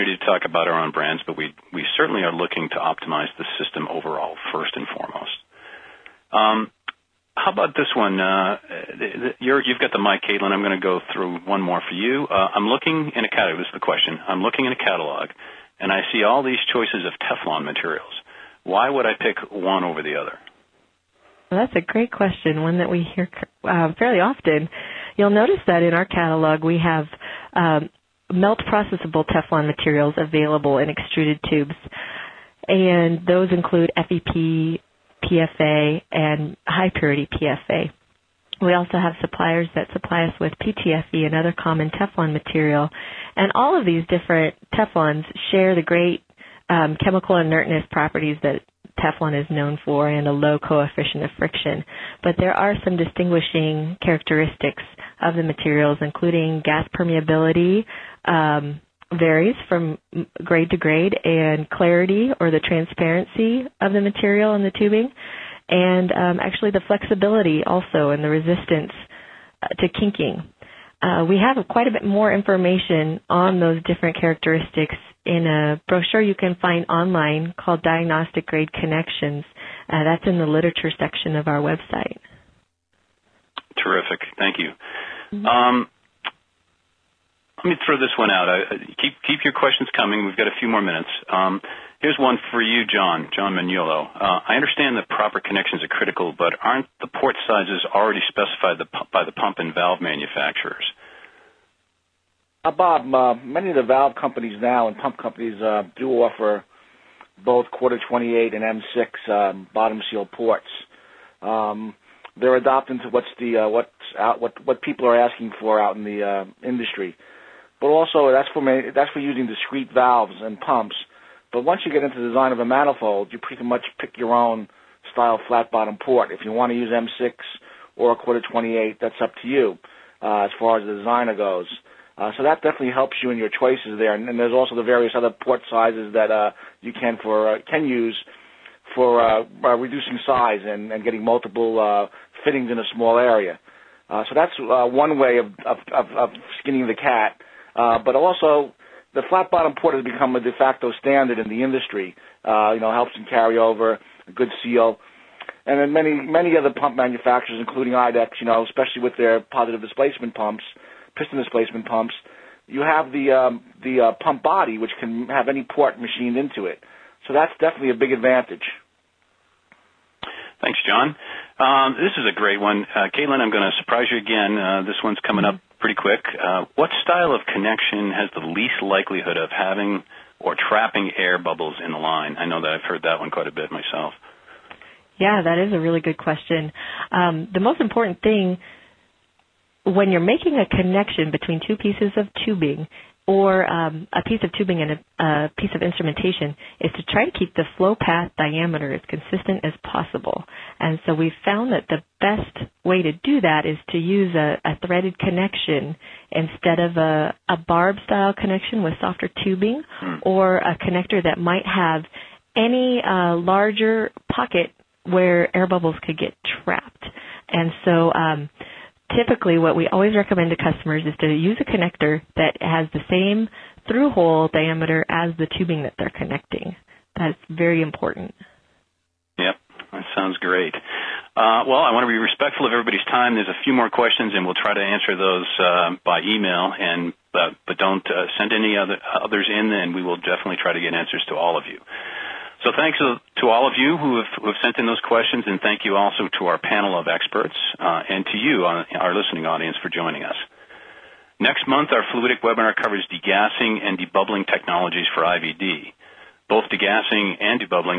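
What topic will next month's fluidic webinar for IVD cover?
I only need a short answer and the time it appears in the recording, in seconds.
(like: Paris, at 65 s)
Degassing and debubbling technologies, at 253 s.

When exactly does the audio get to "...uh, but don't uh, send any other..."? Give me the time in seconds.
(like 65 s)
237 s.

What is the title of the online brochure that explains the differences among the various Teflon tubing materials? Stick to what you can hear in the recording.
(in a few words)
Diagnostic Grade Connections.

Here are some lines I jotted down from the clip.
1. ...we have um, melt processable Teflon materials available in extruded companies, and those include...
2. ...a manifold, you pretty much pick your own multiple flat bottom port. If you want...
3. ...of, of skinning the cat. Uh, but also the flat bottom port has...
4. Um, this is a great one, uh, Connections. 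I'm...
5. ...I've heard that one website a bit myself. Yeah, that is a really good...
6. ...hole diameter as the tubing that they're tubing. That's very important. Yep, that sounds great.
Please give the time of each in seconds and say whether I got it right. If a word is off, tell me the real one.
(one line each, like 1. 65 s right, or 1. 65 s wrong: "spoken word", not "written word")
1. 26 s wrong: "tubes", not "companies"
2. 122 s wrong: "style", not "multiple"
3. 145 s right
4. 171 s wrong: "Caitlin", not "Connections"
5. 182 s wrong: "quite", not "website"
6. 224 s wrong: "connecting", not "tubing".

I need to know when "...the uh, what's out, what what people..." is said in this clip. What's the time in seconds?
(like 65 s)
113 s.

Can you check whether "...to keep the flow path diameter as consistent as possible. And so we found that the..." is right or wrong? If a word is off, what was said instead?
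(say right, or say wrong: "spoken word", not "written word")
right.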